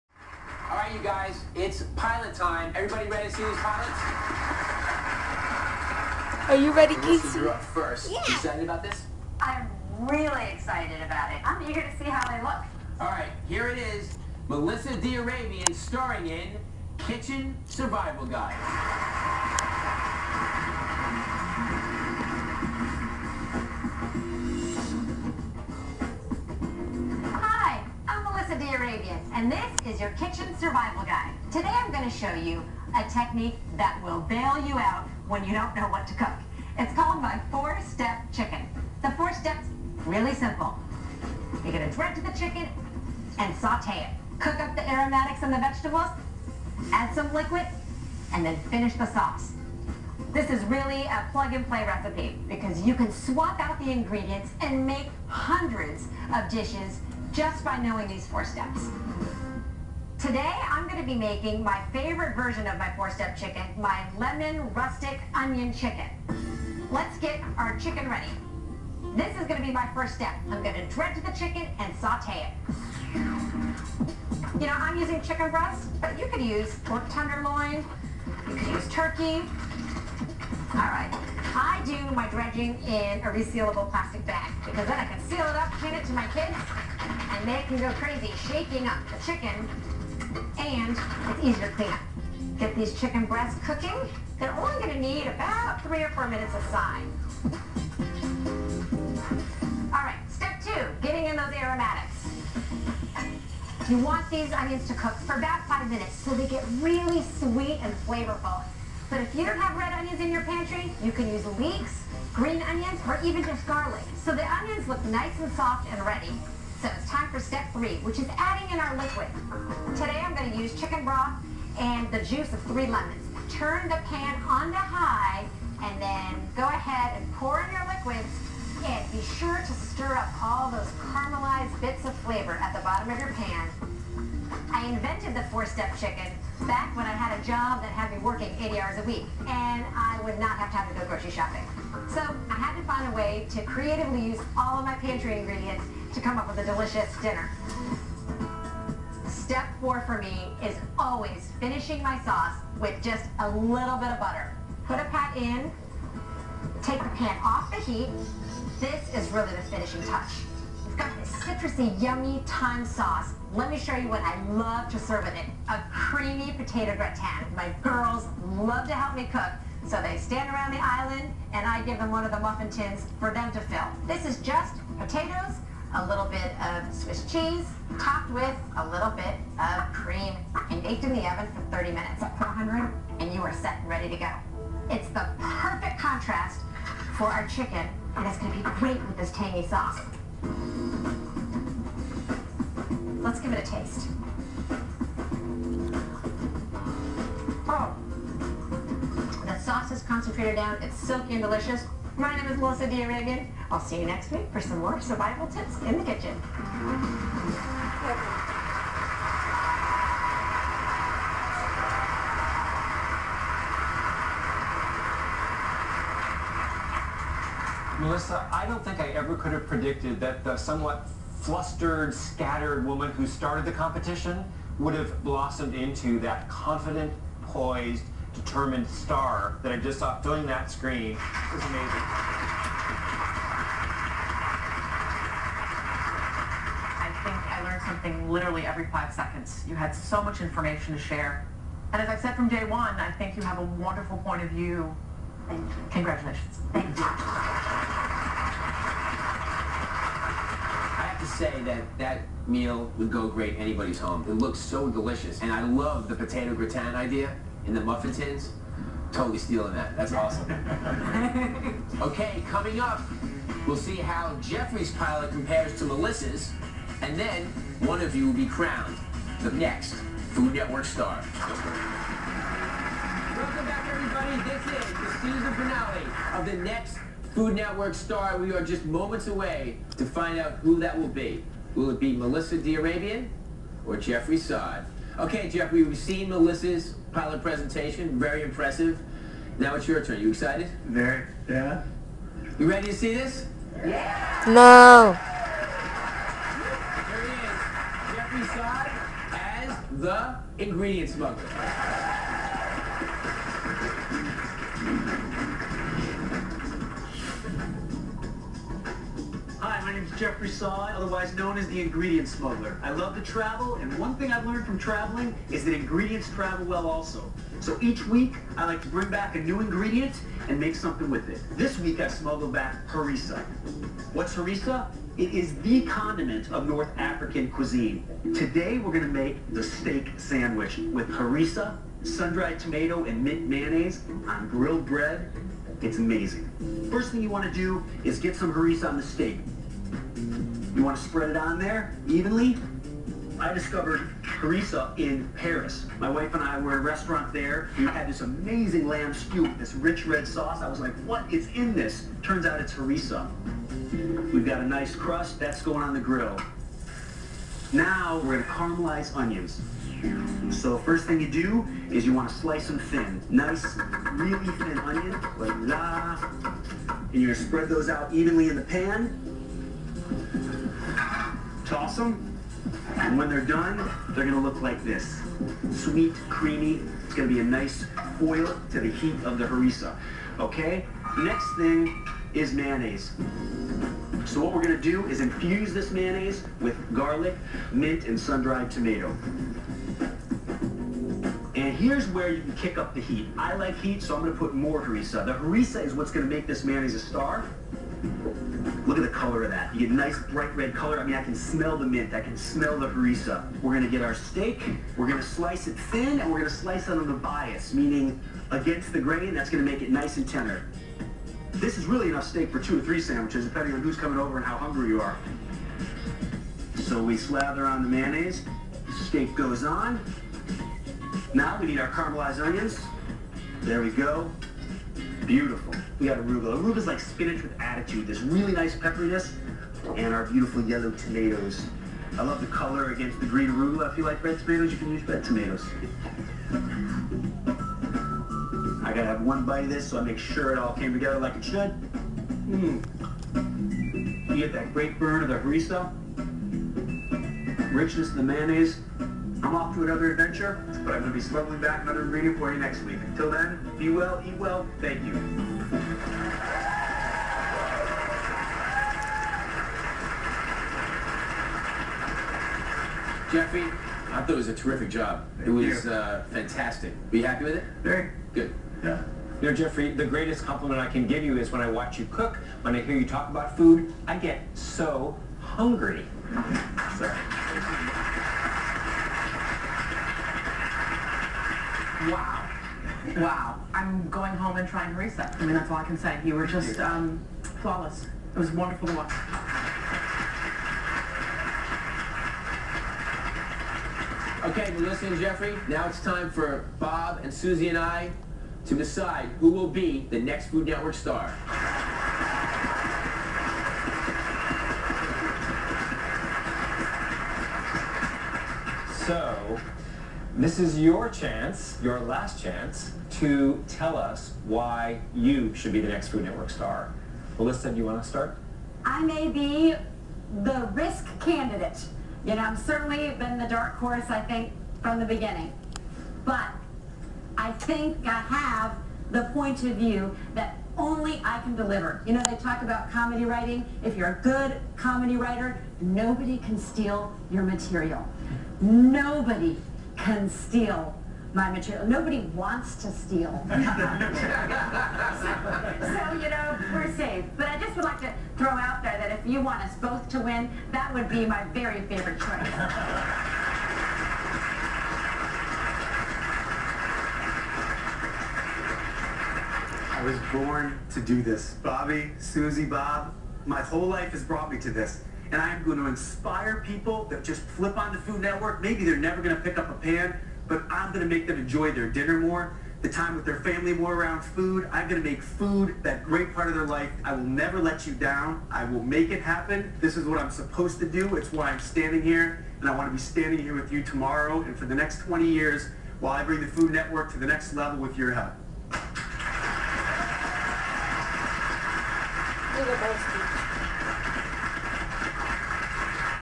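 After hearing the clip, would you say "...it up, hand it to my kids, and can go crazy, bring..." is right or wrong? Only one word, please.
wrong.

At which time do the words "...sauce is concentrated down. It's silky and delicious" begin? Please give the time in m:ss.
3:19.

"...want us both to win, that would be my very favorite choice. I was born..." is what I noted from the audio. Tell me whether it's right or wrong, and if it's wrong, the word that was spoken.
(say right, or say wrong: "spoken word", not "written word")
right.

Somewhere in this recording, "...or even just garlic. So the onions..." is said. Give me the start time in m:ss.
1:53.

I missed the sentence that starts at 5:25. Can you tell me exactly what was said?
It is the condiment of North African cuisine.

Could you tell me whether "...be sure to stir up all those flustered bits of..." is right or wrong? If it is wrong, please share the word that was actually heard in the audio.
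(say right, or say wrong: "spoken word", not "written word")
wrong: "caramelized", not "flustered".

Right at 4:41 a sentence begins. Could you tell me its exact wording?
Will it be Melissa Arabian or Jeffrey Saad?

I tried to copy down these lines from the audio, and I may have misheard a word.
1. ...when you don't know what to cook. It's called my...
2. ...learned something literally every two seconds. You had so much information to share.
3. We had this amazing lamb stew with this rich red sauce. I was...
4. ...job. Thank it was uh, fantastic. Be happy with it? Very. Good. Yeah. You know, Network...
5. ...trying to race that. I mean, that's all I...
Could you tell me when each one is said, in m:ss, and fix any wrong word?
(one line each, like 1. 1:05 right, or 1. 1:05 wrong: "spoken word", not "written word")
1. 0:35 right
2. 3:57 wrong: "five", not "two"
3. 5:47 right
4. 7:44 wrong: "Jeffrey", not "Network"
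5. 8:04 right.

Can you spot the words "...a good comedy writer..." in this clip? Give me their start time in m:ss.
8:54.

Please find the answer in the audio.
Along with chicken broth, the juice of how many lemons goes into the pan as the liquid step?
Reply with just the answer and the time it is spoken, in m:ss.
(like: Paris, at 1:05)
3, at 2:02.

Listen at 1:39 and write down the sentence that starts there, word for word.
All right, step two, getting in those aromatics.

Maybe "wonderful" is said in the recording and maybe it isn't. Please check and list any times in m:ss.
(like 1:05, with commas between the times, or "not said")
4:03, 8:08.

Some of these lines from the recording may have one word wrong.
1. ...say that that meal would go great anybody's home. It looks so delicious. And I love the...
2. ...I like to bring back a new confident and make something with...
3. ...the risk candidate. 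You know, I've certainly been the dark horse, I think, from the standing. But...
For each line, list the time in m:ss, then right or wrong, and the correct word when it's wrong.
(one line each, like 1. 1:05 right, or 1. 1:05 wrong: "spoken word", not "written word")
1. 4:11 right
2. 5:18 wrong: "ingredient", not "confident"
3. 8:40 wrong: "beginning", not "standing".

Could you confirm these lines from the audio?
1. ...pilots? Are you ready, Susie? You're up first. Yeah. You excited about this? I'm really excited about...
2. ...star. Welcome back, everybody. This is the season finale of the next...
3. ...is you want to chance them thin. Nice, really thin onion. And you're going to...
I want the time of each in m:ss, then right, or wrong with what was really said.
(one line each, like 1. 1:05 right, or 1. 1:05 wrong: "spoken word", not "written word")
1. 0:03 wrong: "Casey", not "Susie"
2. 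4:30 right
3. 6:01 wrong: "slice", not "chance".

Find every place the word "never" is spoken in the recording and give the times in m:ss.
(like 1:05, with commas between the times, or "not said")
9:28, 9:37.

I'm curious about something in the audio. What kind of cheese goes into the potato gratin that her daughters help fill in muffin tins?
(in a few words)
Swiss cheese.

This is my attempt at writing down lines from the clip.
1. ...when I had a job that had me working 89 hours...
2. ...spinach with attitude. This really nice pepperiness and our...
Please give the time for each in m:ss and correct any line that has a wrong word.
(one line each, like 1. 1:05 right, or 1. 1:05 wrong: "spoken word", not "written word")
1. 2:16 wrong: "80", not "89"
2. 7:06 right.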